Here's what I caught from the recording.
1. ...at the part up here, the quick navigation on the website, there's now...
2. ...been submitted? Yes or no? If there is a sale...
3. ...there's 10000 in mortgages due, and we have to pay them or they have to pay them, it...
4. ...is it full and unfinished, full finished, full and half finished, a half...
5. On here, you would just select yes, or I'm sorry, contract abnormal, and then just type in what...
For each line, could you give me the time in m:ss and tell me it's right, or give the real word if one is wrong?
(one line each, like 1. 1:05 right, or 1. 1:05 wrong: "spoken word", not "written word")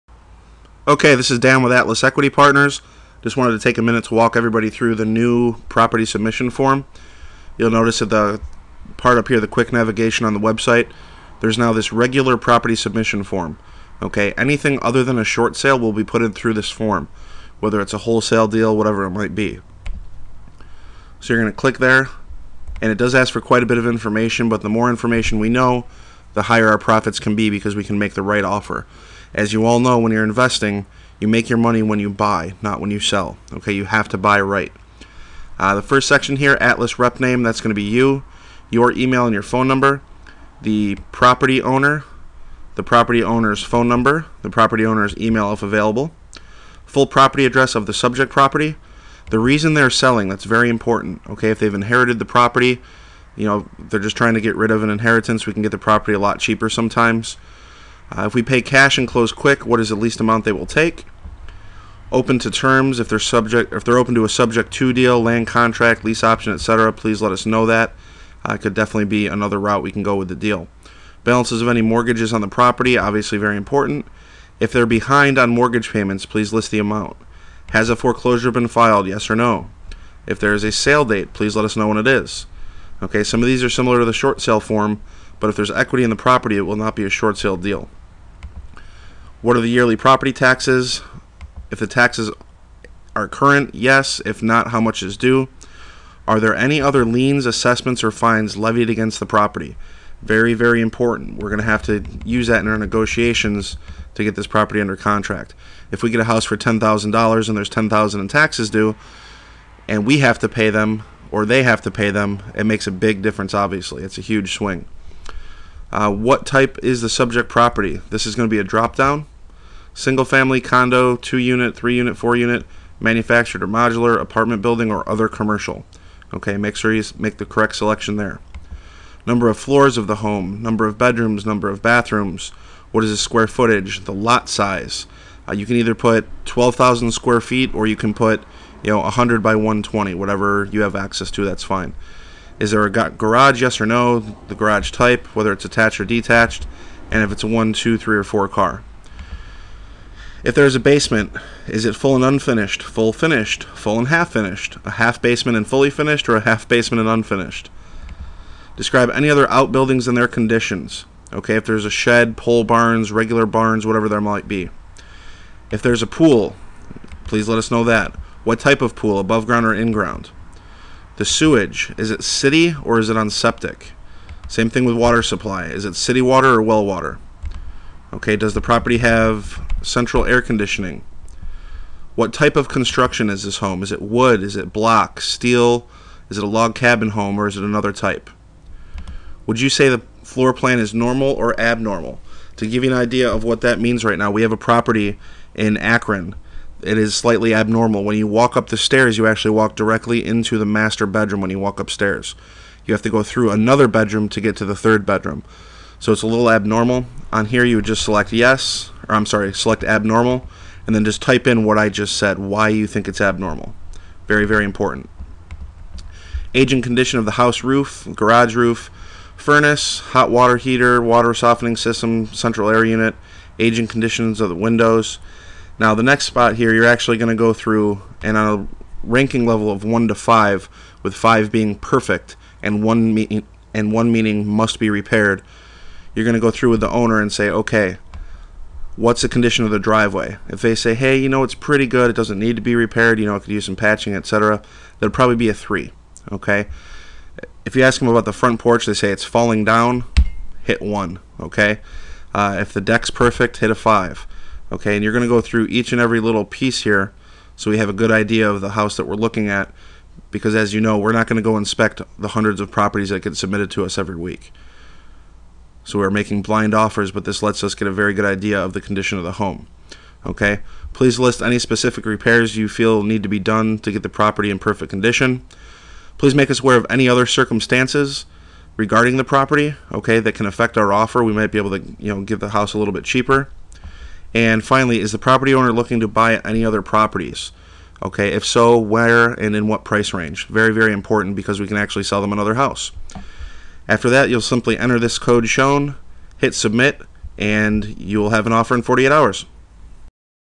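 1. 0:08 right
2. 1:18 wrong: "filed", not "submitted"
3. 1:47 wrong: "taxes", not "mortgages"
4. 2:31 right
5. 3:27 wrong: "select", not "contract".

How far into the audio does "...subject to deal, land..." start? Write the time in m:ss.
1:04.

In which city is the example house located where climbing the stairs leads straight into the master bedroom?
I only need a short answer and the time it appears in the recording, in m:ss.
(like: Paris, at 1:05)
Akron, at 3:15.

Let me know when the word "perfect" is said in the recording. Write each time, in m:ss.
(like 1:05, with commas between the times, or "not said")
3:51, 4:13, 4:34.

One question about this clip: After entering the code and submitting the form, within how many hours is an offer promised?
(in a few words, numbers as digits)
48.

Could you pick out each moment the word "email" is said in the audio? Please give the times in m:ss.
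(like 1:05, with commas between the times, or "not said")
0:38, 0:45.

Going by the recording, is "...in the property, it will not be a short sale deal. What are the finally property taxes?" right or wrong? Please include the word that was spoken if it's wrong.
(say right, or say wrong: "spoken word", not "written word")
wrong: "yearly", not "finally".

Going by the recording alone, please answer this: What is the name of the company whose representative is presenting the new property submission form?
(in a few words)
Atlas Equity Partners.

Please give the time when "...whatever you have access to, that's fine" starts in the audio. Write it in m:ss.
2:20.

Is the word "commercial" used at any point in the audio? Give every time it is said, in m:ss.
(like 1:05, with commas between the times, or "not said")
2:05.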